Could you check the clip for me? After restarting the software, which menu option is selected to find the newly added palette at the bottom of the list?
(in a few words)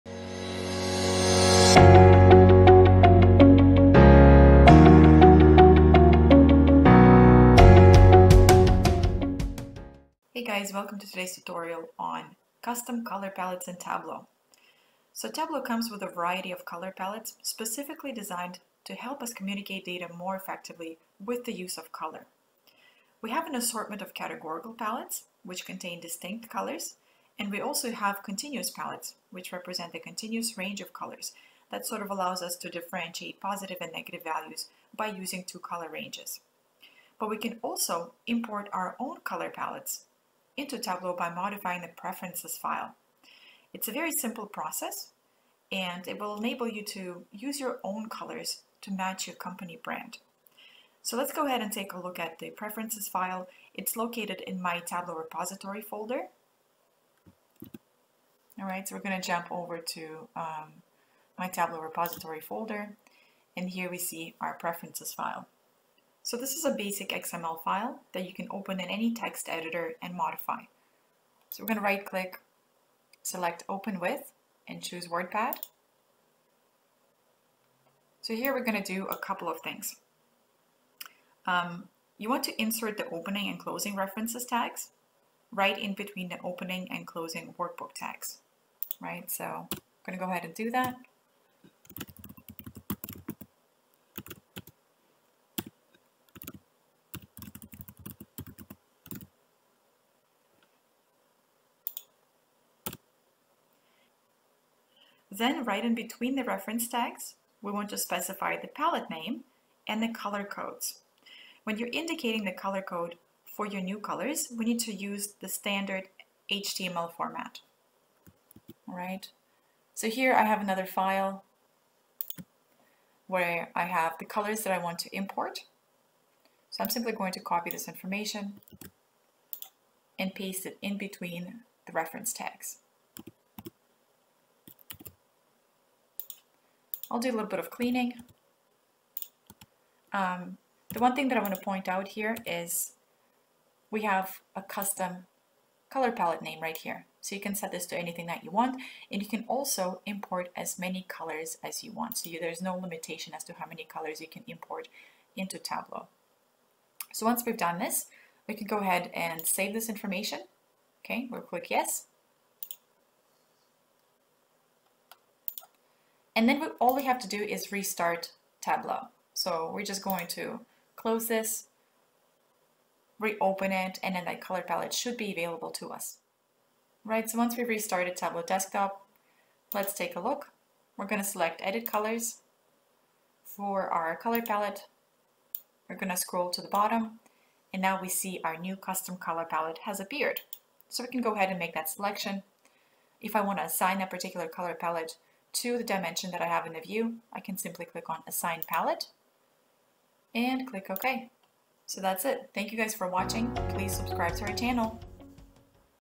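Edit Colors.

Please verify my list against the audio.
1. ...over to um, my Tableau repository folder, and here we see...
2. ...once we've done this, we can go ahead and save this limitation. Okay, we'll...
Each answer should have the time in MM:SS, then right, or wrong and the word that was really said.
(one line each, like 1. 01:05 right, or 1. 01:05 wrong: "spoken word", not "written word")
1. 00:59 right
2. 02:37 wrong: "information", not "limitation".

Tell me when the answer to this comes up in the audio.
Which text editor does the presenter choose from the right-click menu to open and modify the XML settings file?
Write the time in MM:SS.
01:15.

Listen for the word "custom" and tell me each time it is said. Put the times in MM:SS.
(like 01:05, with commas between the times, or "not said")
00:12, 02:24, 03:08.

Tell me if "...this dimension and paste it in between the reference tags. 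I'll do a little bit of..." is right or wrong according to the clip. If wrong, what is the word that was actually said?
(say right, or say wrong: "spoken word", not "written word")
wrong: "information", not "dimension".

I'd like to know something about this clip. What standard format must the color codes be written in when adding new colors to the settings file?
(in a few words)
HTML format.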